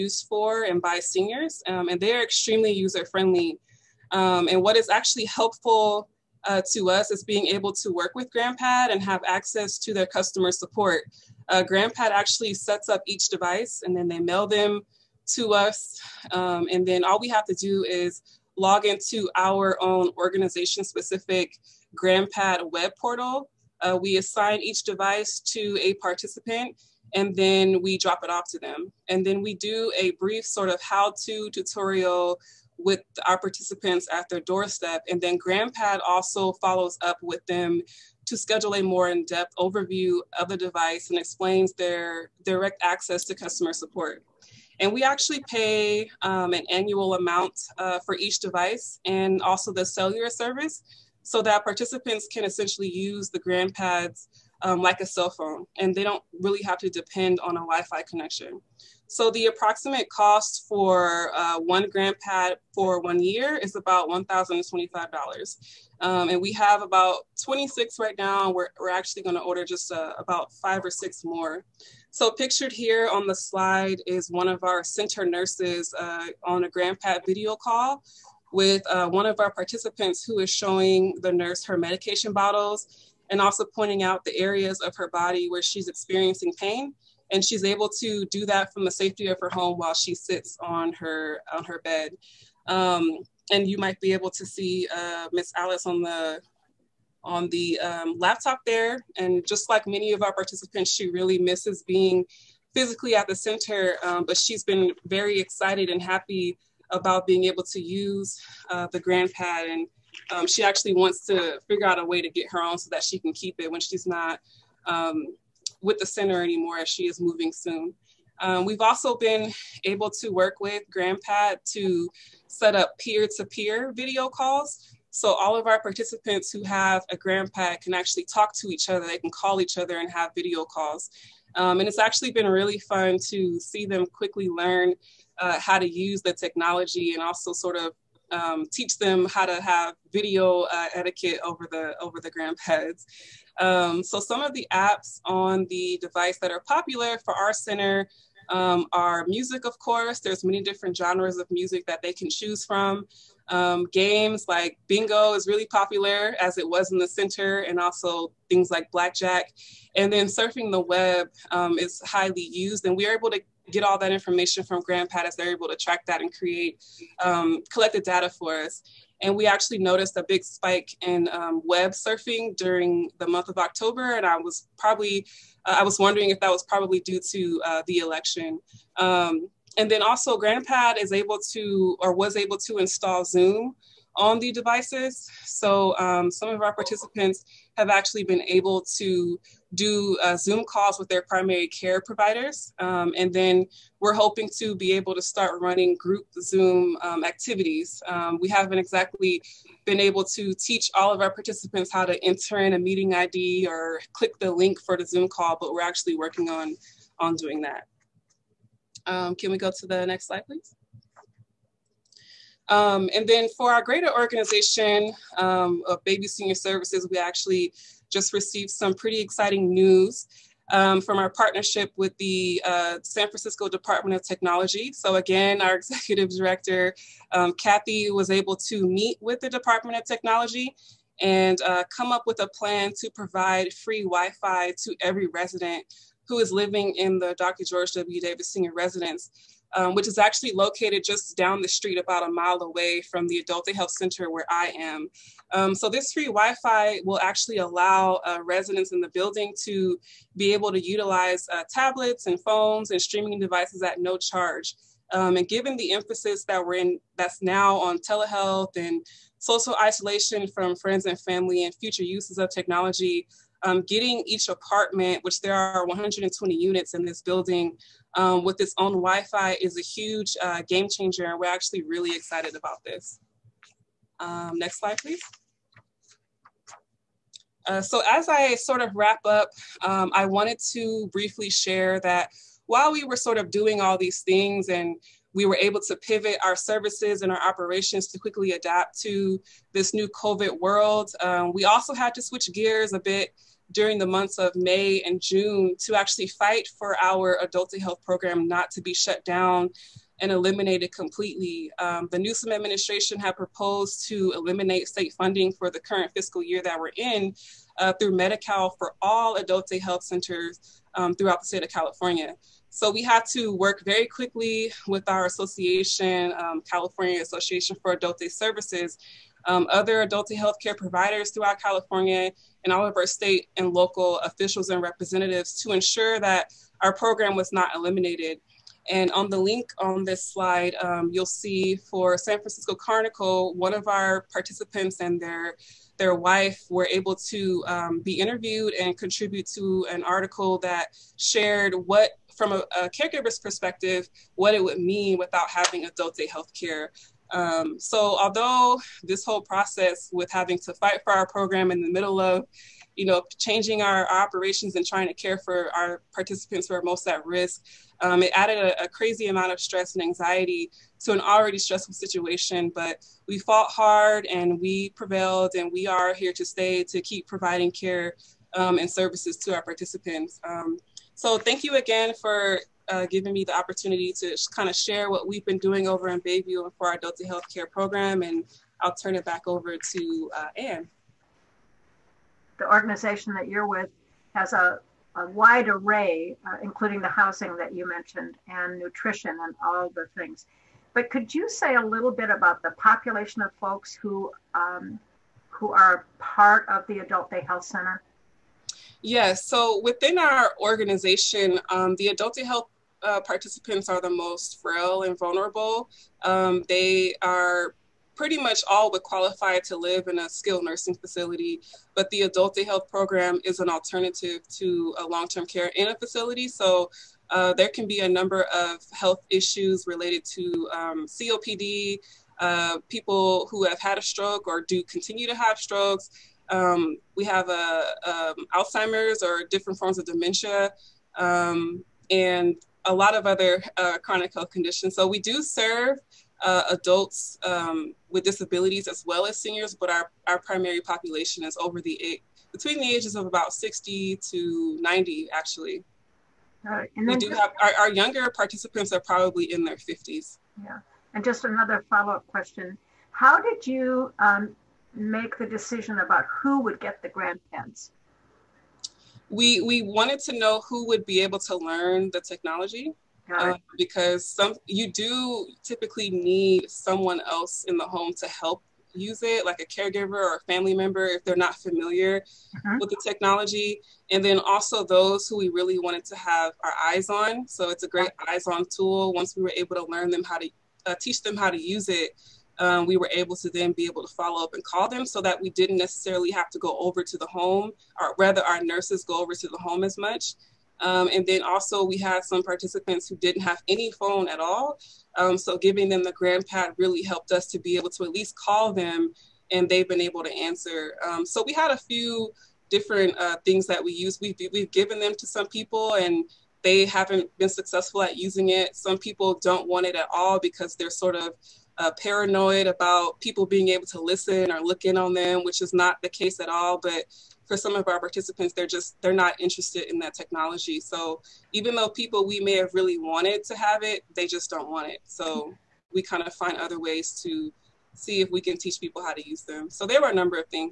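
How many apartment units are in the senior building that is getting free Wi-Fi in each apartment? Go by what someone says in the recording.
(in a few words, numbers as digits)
120.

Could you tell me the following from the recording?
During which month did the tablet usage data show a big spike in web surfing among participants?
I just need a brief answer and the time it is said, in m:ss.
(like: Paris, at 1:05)
October, at 2:53.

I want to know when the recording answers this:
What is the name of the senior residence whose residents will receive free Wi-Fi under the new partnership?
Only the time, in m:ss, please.
3:57.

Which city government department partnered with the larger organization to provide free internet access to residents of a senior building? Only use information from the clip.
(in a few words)
San Francisco Department of Technology.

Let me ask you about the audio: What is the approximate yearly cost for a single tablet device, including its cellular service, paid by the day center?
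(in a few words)
$1,025.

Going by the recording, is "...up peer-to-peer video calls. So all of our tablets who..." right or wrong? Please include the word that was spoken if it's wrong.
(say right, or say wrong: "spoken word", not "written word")
wrong: "participants", not "tablets".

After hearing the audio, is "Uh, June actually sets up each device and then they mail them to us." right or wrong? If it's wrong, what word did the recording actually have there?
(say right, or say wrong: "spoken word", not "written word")
wrong: "GrandPad", not "June".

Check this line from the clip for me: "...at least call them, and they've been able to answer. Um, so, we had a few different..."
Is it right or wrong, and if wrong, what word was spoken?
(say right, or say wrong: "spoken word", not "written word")
right.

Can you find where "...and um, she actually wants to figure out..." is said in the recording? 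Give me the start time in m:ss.
1:49.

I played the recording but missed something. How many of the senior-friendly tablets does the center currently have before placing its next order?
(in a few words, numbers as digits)
26.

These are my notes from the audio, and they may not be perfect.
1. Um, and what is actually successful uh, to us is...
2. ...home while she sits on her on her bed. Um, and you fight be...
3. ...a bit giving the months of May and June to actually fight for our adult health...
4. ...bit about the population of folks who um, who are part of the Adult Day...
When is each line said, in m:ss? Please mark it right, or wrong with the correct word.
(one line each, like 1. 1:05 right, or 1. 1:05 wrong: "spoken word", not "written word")
1. 0:04 wrong: "helpful", not "successful"
2. 1:29 wrong: "might", not "fight"
3. 4:52 wrong: "during", not "giving"
4. 6:32 right.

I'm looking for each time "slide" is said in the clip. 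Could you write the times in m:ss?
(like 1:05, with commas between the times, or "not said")
1:13, 3:30, 4:34, 5:30.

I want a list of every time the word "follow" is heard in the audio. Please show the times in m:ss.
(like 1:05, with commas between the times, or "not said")
0:36, 7:31, 8:04.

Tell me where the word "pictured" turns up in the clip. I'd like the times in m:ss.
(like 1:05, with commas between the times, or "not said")
1:12.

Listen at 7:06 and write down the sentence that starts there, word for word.
Um, we have uh, um, Alzheimer's or different forms of dementia.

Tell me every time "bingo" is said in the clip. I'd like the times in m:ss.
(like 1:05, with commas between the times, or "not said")
2:34.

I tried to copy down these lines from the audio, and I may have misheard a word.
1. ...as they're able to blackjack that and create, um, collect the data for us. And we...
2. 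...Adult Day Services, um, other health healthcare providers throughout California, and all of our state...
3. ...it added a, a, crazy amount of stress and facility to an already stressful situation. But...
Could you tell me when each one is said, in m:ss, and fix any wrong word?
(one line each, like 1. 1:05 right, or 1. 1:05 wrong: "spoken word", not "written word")
1. 2:45 wrong: "track", not "blackjack"
2. 5:17 right
3. 5:58 wrong: "anxiety", not "facility".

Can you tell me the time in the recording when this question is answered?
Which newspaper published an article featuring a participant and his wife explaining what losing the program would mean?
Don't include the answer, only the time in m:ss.
5:32.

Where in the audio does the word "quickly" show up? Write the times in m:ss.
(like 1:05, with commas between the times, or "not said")
2:14, 4:48, 5:14.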